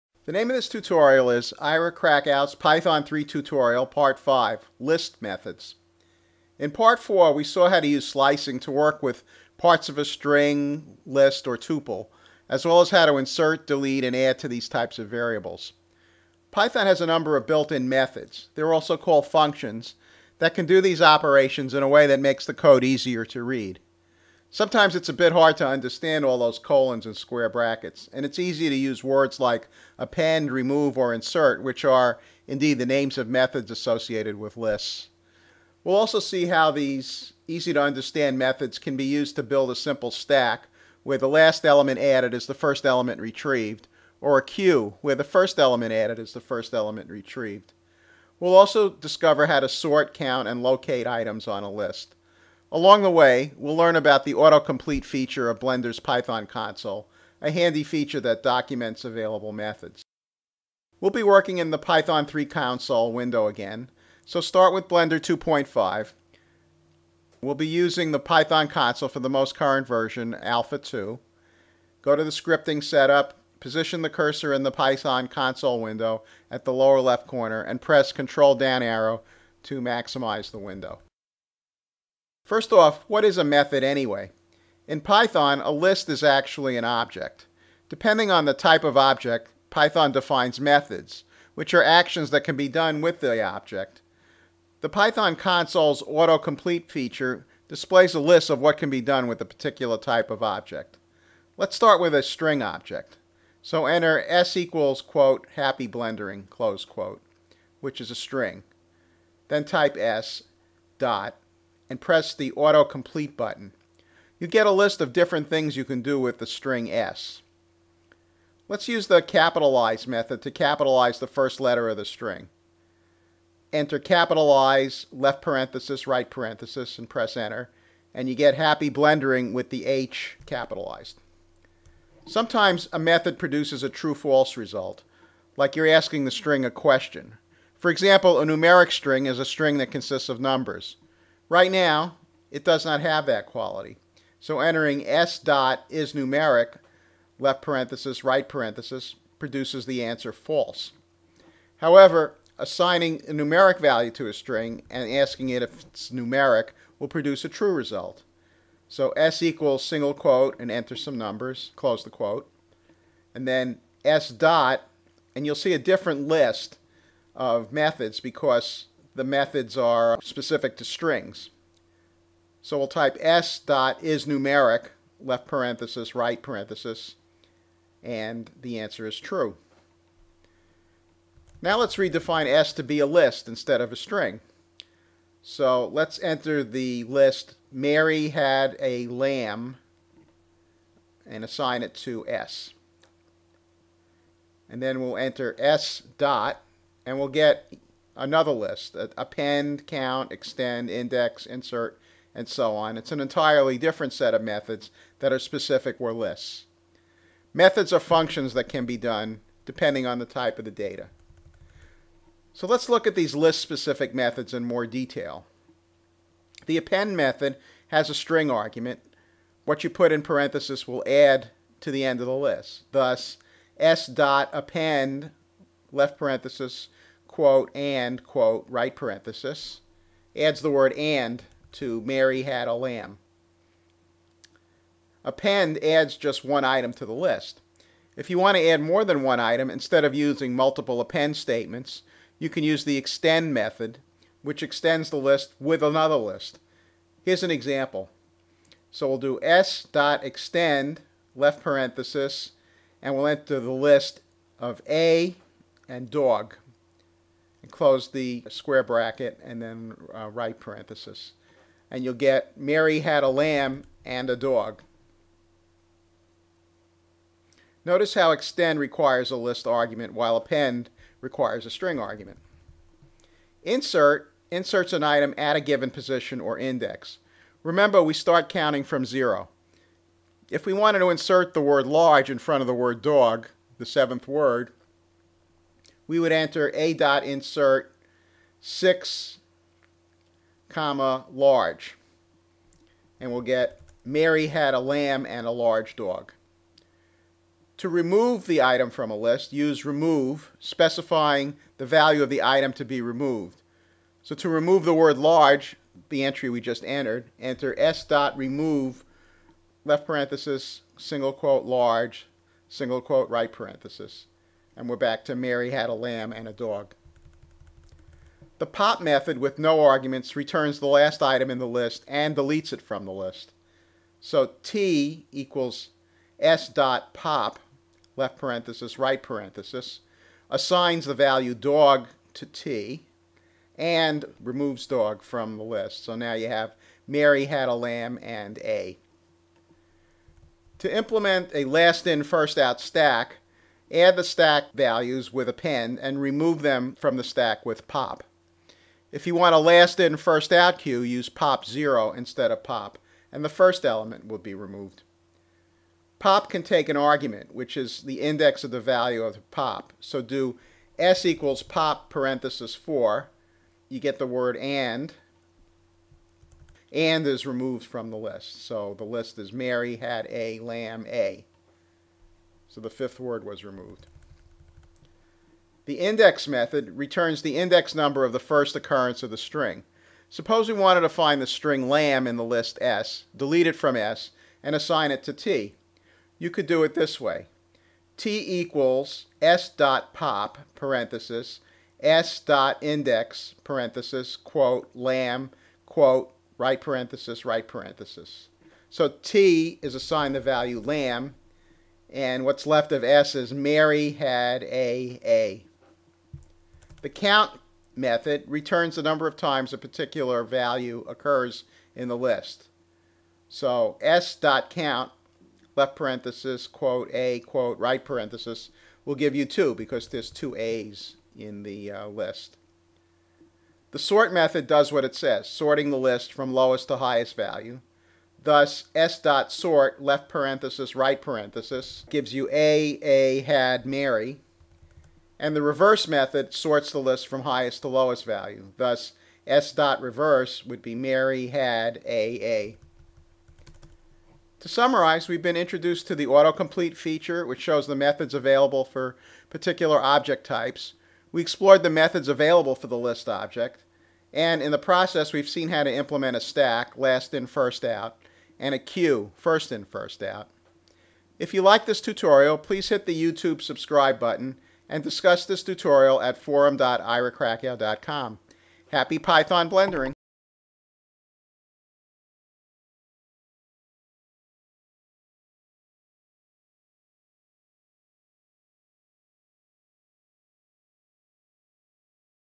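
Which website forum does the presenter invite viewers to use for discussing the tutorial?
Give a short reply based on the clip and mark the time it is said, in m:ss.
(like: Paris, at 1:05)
forum.irakrakow.com, at 7:46.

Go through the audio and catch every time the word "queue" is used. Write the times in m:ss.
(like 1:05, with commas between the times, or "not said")
0:44, 5:50, 7:38.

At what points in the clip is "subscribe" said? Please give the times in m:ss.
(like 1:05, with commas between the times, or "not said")
7:43.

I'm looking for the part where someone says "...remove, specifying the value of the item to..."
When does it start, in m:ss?
4:59.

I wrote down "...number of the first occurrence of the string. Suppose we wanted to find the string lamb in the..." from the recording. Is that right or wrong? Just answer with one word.
right.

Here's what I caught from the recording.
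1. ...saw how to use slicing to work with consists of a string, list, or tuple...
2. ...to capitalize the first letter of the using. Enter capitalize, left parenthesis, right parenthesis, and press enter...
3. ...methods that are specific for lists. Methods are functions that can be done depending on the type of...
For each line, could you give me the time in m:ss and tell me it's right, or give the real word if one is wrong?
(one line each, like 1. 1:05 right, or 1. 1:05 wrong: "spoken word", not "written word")
1. 0:07 wrong: "parts", not "consists"
2. 2:00 wrong: "string", not "using"
3. 3:24 right.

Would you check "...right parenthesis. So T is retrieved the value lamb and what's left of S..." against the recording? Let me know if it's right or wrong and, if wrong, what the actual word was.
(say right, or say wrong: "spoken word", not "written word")
wrong: "assigned", not "retrieved".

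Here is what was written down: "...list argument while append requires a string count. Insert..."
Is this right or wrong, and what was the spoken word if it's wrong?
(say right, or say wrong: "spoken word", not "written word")
wrong: "argument", not "count".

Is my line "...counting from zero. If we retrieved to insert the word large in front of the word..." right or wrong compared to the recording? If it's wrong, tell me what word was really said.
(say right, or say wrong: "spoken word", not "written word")
wrong: "wanted", not "retrieved".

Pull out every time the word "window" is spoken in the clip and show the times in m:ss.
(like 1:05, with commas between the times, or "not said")
1:03, 1:15, 1:20.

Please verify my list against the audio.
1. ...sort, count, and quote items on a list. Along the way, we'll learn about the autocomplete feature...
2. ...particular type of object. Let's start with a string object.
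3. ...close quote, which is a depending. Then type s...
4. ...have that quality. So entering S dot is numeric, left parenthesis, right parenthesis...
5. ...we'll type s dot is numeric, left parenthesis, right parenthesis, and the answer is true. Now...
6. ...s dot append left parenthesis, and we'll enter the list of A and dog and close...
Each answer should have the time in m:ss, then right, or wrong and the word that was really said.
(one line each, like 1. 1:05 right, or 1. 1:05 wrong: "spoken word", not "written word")
1. 0:49 wrong: "locate", not "quote"
2. 1:39 right
3. 1:46 wrong: "string", not "depending"
4. 2:23 right
5. 2:52 right
6. 4:09 wrong: "extend", not "append".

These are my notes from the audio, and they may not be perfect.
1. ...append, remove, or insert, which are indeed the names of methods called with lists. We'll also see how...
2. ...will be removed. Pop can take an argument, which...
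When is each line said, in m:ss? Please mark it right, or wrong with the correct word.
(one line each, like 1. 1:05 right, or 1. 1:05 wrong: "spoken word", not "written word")
1. 0:29 wrong: "associated", not "called"
2. 5:54 right.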